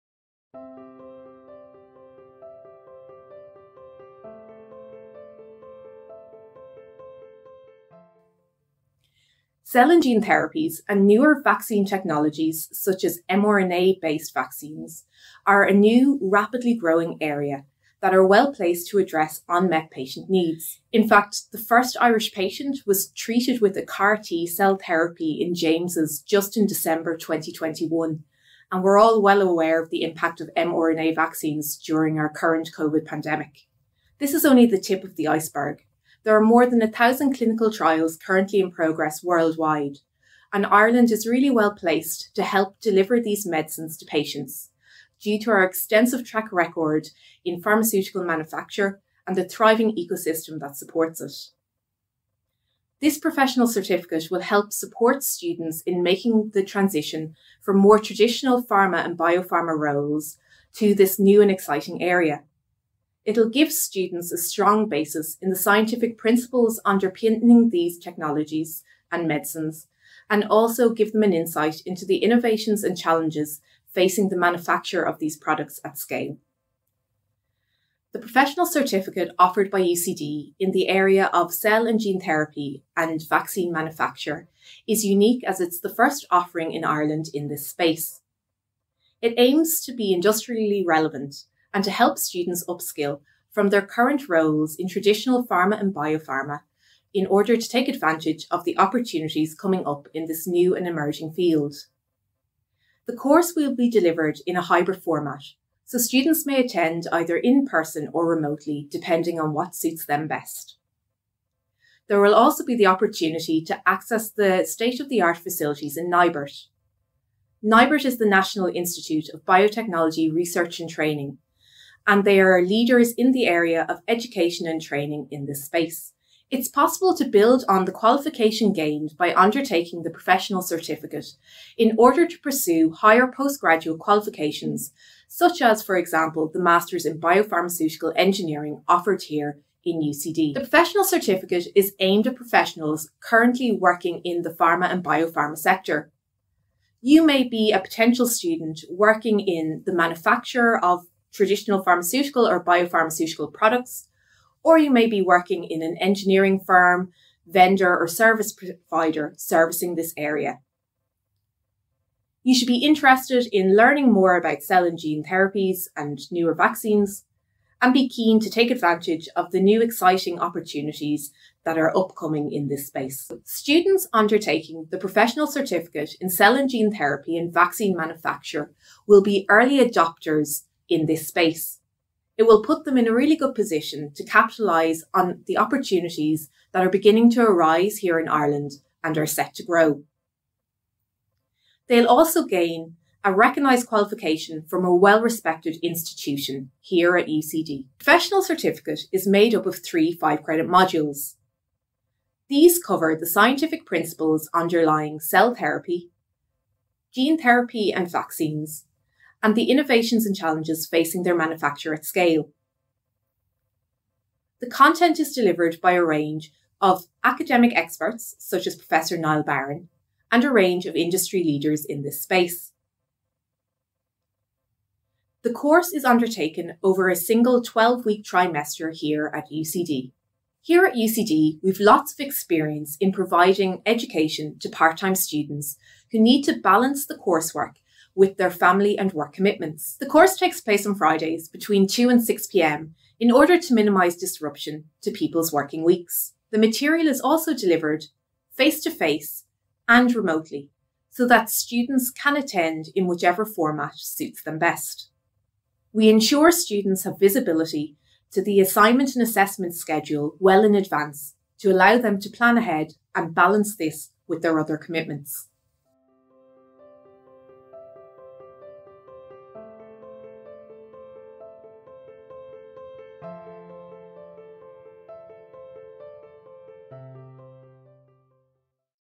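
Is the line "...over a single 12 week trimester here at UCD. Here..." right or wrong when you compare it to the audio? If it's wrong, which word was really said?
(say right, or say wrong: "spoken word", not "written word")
right.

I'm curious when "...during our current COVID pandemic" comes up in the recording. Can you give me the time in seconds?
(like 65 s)
31 s.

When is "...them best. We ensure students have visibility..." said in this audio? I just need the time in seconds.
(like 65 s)
254 s.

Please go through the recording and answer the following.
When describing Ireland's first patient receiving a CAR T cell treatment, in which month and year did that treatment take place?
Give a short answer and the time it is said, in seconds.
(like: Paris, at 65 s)
December 2021, at 26 s.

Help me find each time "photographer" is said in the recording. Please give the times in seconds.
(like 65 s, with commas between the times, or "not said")
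not said.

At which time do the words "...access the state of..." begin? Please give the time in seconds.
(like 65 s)
113 s.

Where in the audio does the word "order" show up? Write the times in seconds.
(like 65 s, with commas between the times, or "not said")
97 s, 131 s, 243 s.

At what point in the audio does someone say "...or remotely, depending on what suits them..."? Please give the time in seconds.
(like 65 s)
108 s.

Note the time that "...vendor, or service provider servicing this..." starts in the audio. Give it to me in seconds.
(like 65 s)
157 s.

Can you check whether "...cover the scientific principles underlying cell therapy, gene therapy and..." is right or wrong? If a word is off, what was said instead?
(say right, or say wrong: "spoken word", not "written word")
right.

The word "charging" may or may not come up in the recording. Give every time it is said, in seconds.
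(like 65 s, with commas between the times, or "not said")
not said.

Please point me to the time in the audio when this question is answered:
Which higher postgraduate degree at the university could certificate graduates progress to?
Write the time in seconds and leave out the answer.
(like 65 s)
136 s.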